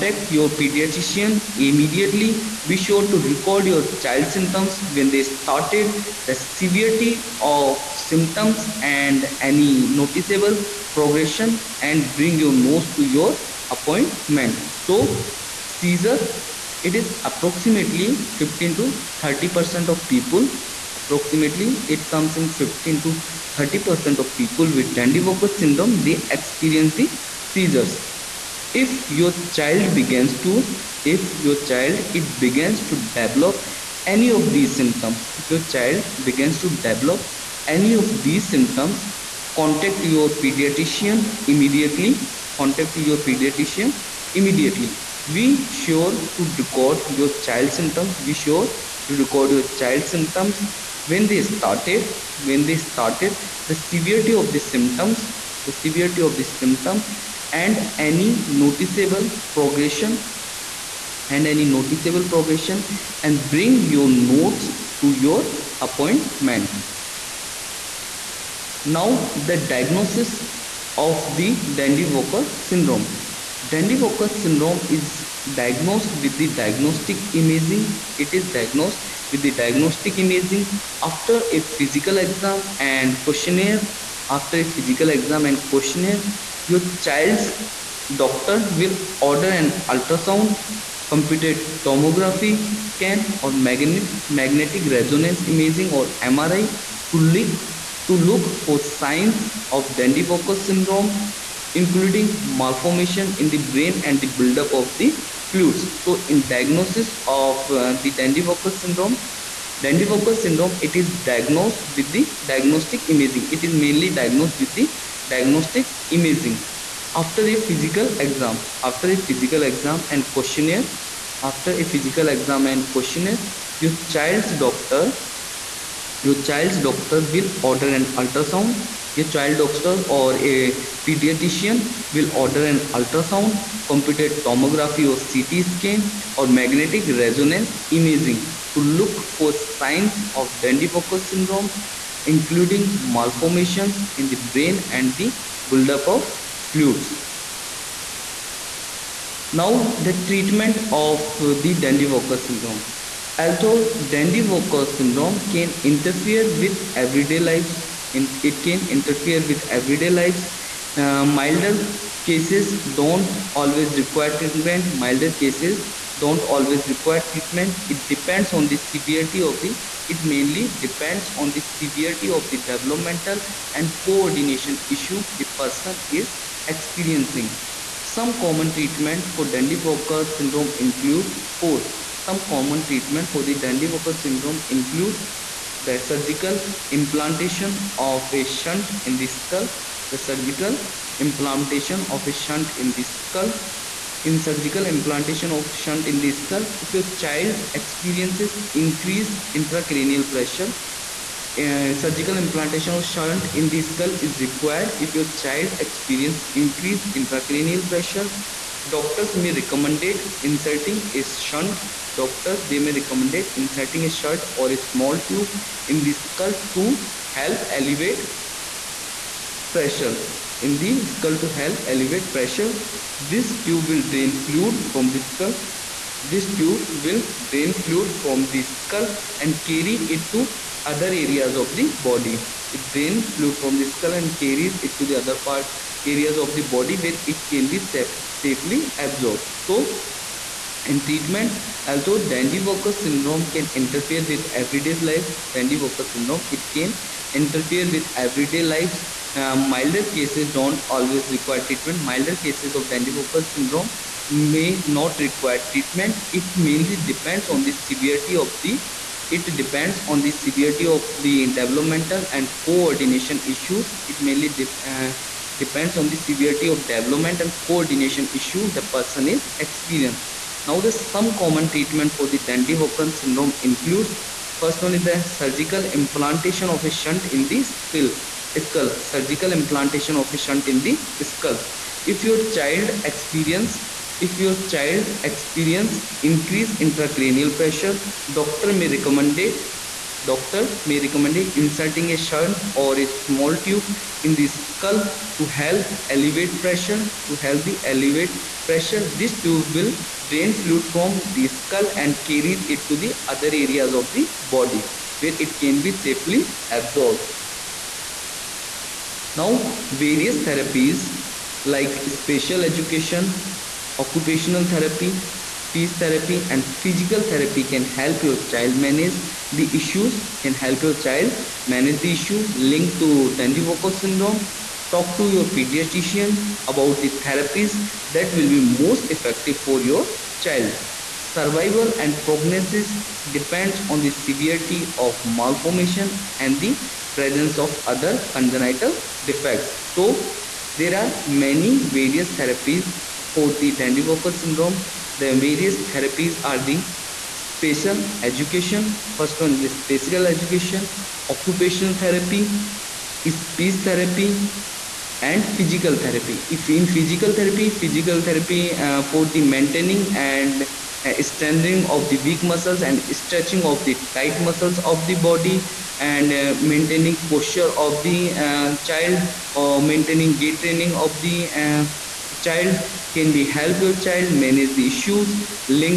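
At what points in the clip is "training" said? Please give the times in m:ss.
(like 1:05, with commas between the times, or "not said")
6:10.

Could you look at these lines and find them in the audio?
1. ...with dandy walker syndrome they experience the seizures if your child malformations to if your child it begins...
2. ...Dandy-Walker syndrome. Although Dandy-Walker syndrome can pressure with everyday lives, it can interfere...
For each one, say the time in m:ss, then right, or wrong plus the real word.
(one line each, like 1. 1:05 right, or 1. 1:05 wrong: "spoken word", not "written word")
1. 0:24 wrong: "begins", not "malformations"
2. 2:31 wrong: "interfere", not "pressure".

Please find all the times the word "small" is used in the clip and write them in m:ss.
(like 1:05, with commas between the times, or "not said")
3:34, 4:53.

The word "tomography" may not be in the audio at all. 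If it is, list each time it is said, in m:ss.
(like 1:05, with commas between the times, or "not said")
1:31, 2:14.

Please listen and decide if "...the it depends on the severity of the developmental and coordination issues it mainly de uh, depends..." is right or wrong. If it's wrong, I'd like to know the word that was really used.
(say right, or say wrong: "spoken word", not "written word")
right.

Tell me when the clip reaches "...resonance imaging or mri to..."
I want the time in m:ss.
1:34.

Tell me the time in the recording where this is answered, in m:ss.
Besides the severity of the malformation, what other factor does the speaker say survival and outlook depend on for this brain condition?
5:37.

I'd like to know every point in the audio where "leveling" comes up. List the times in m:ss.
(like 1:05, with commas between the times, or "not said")
not said.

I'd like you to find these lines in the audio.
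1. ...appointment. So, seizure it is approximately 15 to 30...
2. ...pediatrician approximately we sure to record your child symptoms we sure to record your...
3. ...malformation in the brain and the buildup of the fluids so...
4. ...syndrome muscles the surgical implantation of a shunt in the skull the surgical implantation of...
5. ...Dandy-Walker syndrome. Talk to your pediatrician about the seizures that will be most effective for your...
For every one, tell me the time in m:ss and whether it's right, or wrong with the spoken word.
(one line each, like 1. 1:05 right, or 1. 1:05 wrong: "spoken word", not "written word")
1. 0:13 right
2. 0:43 wrong: "immediately", not "approximately"
3. 1:42 right
4. 3:04 wrong: "includes", not "muscles"
5. 5:23 wrong: "therapies", not "seizures".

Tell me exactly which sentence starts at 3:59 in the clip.
So in treatment, although Dandy-Walker syndrome can interfere with everyday life, Dandy-Walker syndrome, it can interfere with everyday lives.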